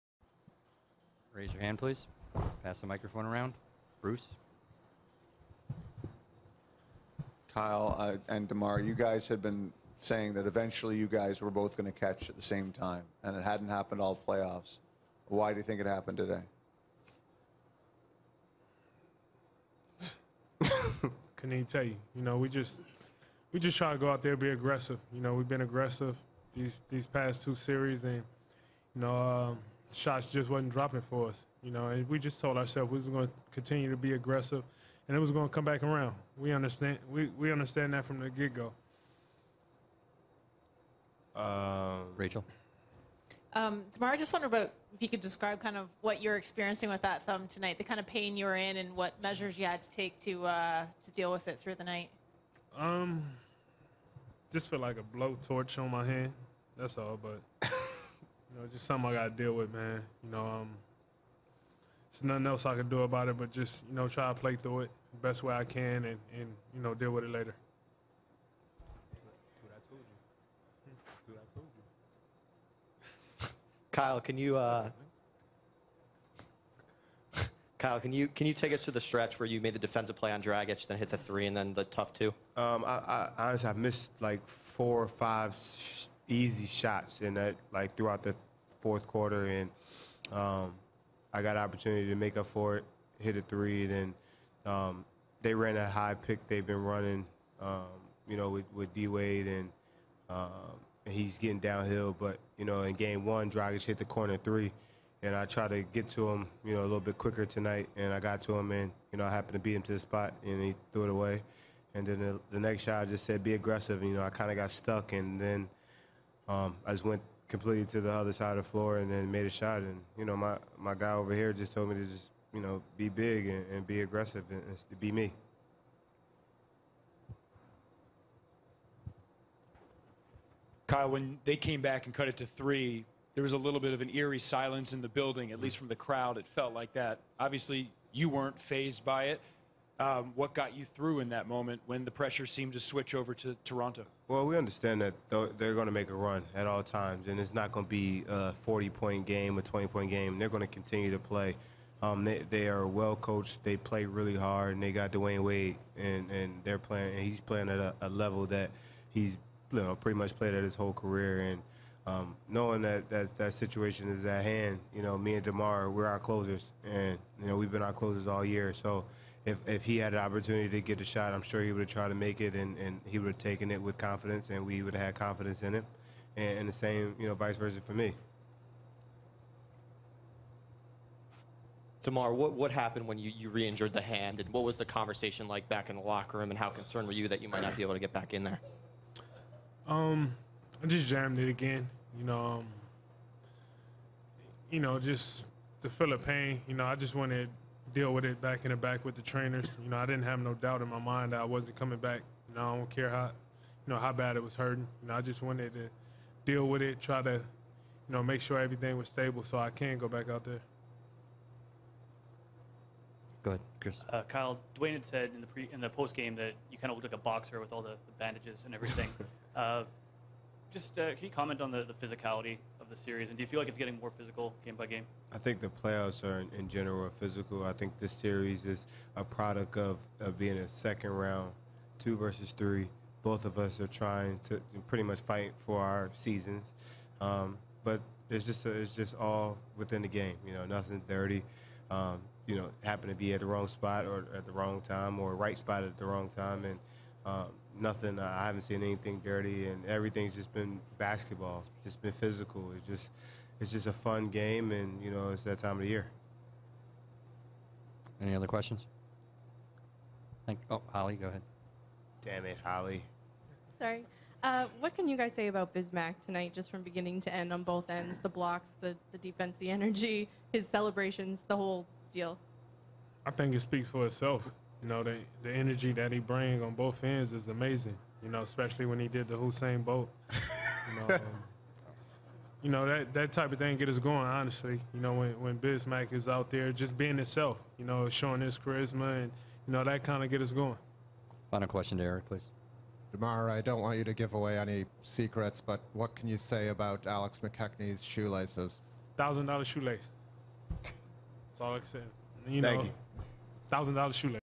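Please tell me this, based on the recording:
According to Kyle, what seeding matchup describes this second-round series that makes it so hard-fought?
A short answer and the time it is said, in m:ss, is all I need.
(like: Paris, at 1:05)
two versus three, at 3:51.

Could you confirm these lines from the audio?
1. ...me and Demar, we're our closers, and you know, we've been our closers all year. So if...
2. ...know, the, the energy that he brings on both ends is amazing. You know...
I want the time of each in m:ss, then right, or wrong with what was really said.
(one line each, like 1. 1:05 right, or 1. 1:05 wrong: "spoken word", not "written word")
1. 2:45 right
2. 4:34 right.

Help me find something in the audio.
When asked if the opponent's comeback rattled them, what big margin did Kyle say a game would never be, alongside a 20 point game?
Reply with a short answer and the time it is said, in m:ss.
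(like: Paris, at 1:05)
40 points, at 2:28.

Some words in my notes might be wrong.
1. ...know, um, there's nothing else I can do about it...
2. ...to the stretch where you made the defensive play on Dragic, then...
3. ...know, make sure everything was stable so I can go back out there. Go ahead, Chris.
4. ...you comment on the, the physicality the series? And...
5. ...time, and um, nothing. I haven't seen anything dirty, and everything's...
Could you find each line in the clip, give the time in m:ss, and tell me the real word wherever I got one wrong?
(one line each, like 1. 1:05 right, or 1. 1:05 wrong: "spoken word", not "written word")
1. 1:00 right
2. 1:18 right
3. 3:28 right
4. 3:41 right
5. 4:06 right.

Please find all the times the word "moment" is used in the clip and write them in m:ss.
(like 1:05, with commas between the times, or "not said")
2:21.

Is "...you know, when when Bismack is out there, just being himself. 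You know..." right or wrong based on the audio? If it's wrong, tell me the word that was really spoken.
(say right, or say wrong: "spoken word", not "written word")
right.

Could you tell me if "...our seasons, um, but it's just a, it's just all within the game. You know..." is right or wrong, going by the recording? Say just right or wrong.
right.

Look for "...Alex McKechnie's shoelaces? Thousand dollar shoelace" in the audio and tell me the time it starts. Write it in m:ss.
4:57.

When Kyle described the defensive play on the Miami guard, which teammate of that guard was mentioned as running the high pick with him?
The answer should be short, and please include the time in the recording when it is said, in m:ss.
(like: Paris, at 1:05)
D Wade, at 1:38.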